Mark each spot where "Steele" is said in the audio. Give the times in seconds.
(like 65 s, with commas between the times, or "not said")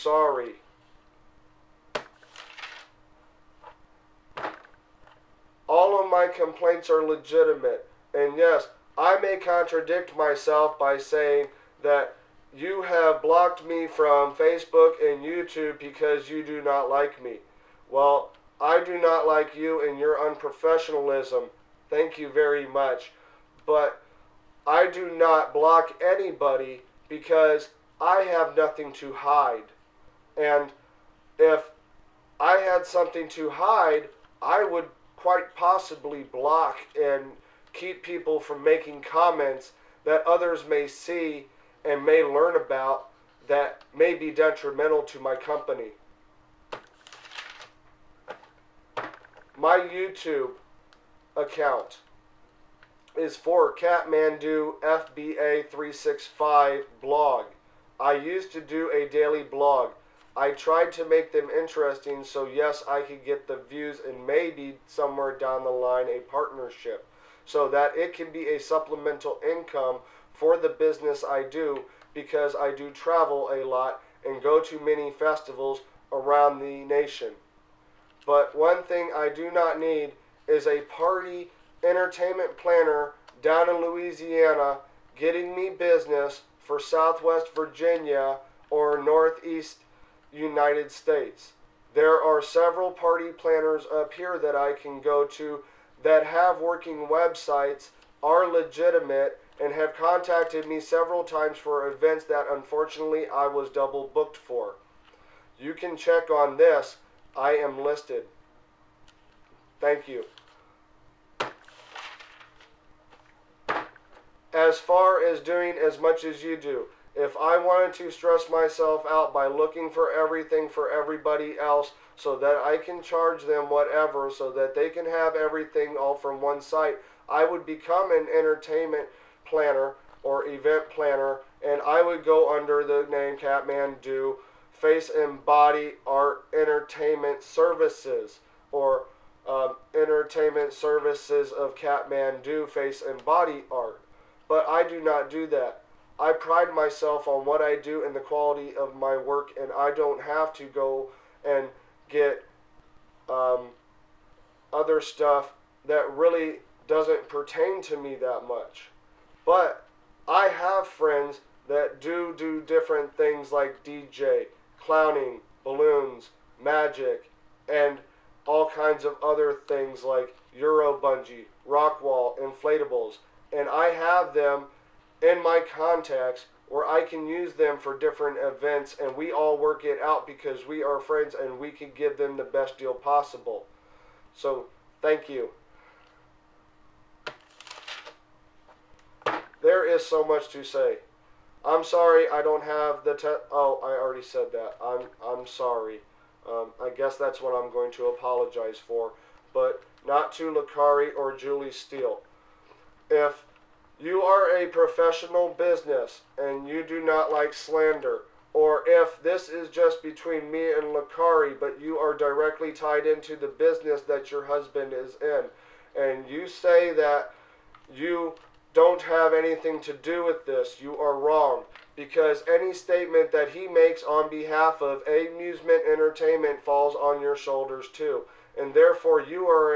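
201 s.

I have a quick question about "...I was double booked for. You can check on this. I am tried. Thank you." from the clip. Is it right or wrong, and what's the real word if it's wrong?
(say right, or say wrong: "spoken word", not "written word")
wrong: "listed", not "tried".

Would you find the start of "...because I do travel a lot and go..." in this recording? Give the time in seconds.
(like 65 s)
72 s.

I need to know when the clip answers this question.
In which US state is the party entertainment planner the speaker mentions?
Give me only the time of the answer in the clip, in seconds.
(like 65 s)
83 s.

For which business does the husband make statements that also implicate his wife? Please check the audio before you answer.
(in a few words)
Amusement Entertainment.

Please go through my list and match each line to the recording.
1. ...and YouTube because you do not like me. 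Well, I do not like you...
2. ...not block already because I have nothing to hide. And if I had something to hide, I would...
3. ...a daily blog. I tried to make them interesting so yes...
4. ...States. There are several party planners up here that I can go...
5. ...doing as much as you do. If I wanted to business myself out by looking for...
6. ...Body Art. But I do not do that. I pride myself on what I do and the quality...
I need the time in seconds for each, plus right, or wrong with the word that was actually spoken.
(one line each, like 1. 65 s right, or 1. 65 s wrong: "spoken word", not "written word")
1. 15 s right
2. 25 s wrong: "anybody", not "already"
3. 58 s right
4. 90 s right
5. 115 s wrong: "stress", not "business"
6. 143 s right.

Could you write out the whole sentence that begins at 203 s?
If you are a professional business and you do not like slander.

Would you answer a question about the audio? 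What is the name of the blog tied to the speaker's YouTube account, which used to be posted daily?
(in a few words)
Katmandew FBA 365.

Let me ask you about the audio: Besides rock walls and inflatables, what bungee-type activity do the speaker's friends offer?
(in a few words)
Euro bungee.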